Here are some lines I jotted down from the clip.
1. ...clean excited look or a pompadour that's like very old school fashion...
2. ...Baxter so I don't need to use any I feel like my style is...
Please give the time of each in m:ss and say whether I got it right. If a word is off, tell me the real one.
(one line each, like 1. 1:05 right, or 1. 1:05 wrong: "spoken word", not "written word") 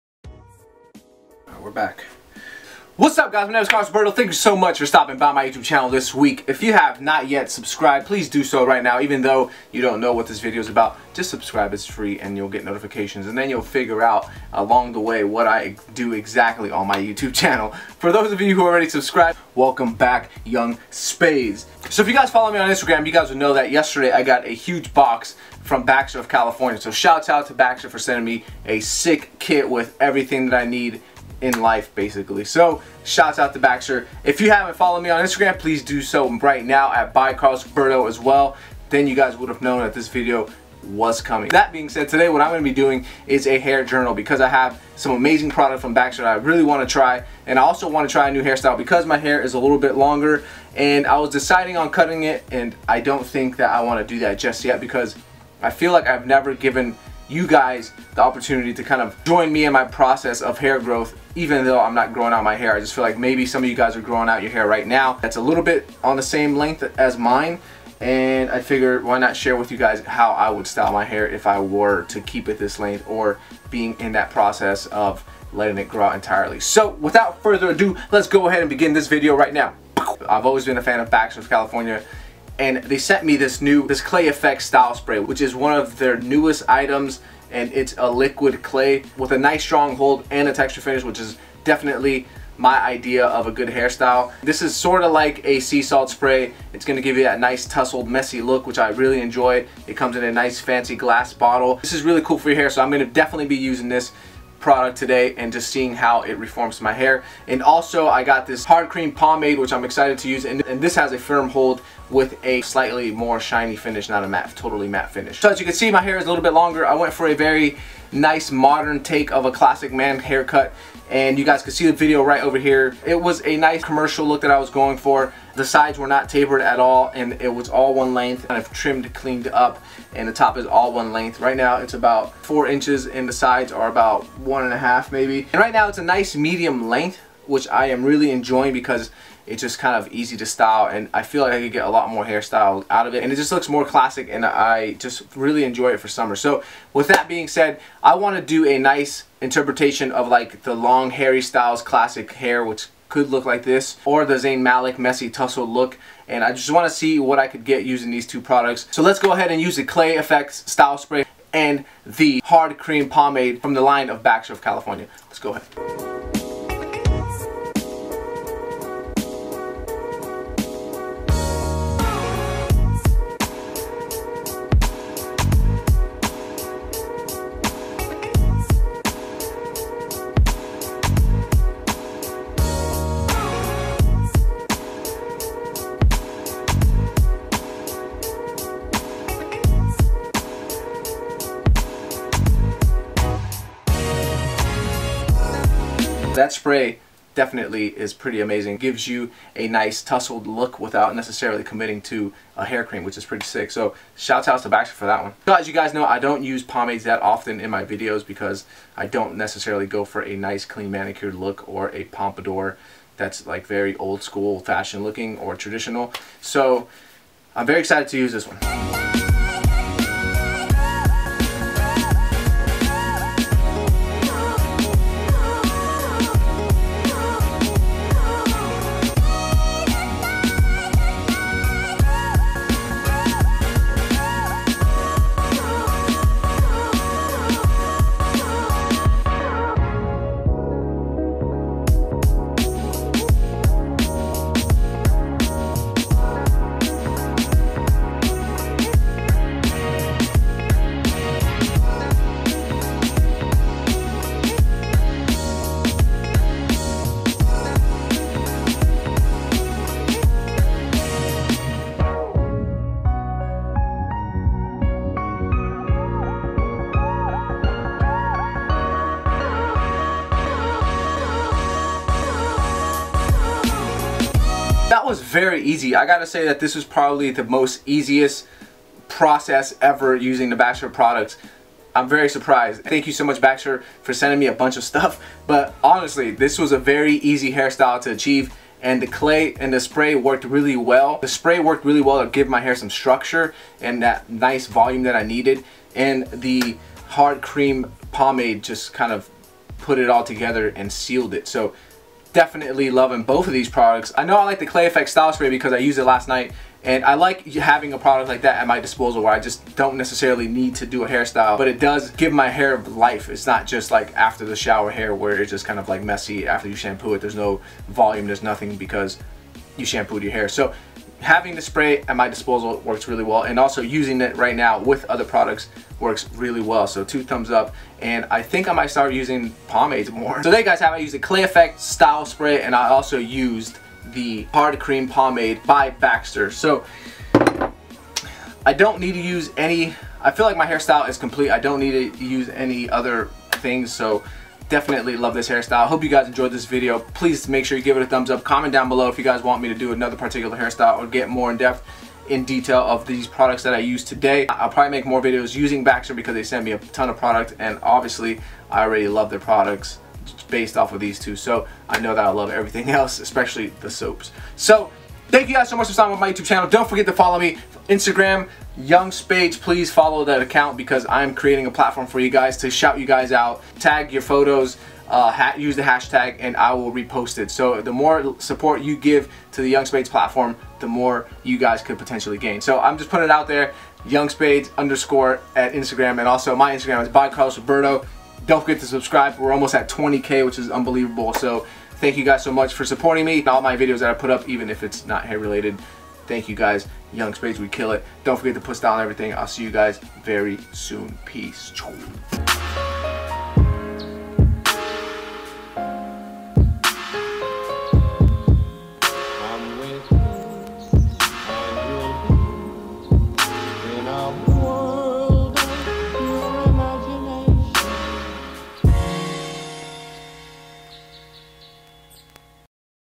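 1. 3:30 wrong: "manicured", not "excited"
2. 5:35 wrong: "hairstyle", not "style".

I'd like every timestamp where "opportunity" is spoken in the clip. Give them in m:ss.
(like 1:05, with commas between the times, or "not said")
0:58.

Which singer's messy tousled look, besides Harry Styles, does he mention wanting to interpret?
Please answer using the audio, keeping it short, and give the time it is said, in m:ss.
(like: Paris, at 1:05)
Zayn Malik, at 2:34.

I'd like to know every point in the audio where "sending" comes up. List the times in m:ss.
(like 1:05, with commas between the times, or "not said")
0:27, 4:44.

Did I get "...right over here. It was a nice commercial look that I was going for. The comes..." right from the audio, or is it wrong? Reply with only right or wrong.
wrong.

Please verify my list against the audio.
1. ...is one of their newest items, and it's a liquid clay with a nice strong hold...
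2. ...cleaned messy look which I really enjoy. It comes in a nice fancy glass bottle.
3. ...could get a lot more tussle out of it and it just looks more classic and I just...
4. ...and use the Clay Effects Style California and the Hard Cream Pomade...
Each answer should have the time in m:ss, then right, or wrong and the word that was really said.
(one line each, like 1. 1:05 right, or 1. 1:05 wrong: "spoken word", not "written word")
1. 1:25 right
2. 1:37 wrong: "tussled", not "cleaned"
3. 2:21 wrong: "hairstyle", not "tussle"
4. 2:39 wrong: "Spray", not "California".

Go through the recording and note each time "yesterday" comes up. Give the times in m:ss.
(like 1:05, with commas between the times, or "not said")
0:23.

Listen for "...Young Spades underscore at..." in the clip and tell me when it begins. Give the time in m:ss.
6:24.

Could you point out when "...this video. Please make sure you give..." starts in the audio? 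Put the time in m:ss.
5:46.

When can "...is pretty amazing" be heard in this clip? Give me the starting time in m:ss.
3:17.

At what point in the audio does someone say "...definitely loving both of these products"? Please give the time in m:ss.
5:02.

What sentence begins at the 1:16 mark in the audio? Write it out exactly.
So without further ado, let's go ahead and begin this video right now.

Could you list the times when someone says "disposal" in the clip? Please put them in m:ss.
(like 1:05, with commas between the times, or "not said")
5:08, 5:22.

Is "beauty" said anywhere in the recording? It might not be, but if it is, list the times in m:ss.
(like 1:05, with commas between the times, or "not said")
not said.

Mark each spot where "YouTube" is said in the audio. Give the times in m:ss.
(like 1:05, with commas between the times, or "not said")
0:05, 0:16, 6:06.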